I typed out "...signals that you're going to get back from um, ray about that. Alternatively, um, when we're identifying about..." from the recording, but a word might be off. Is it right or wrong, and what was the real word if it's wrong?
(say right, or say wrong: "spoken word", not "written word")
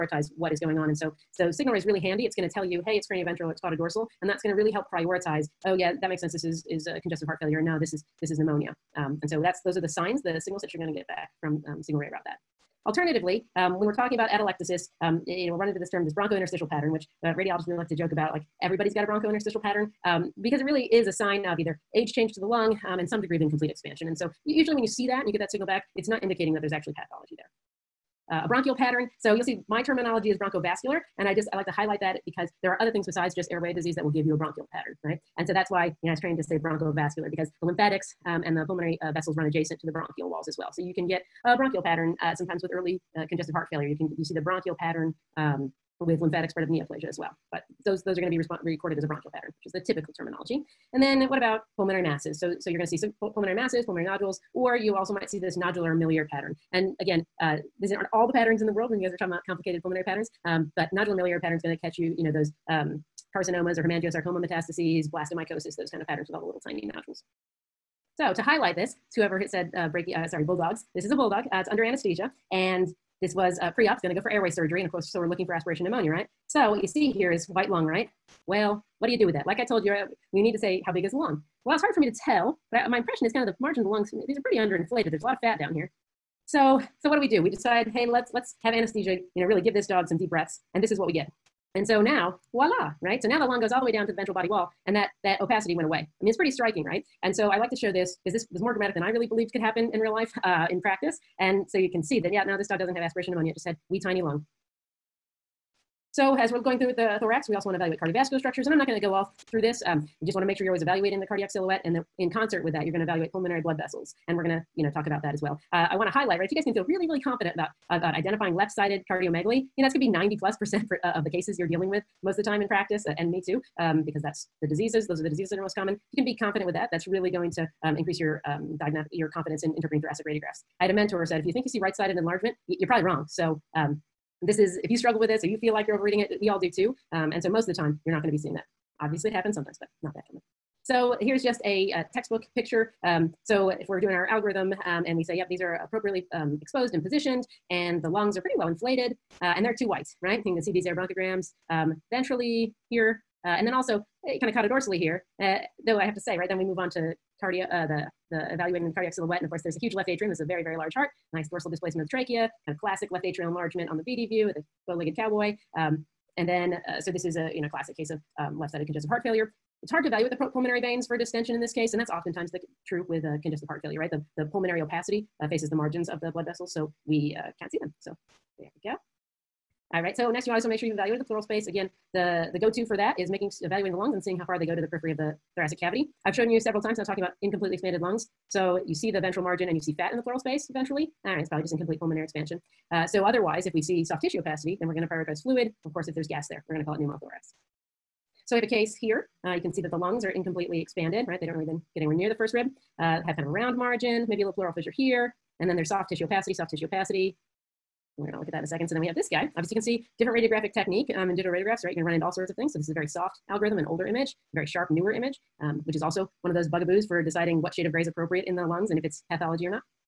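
wrong: "talking", not "identifying".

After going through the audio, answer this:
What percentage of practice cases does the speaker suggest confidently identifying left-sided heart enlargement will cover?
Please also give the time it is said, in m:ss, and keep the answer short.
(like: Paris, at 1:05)
90 plus percent, at 2:00.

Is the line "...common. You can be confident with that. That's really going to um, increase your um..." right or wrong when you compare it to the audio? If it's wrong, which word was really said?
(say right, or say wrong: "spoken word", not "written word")
right.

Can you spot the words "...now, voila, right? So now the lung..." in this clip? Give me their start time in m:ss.
1:32.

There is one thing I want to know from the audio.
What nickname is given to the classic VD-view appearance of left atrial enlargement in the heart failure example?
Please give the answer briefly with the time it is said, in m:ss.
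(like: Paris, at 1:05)
bow-legged cowboy, at 2:44.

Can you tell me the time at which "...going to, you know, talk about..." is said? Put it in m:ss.
1:54.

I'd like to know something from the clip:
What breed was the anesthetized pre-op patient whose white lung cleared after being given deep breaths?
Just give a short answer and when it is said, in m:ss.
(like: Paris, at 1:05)
Bulldog, at 1:10.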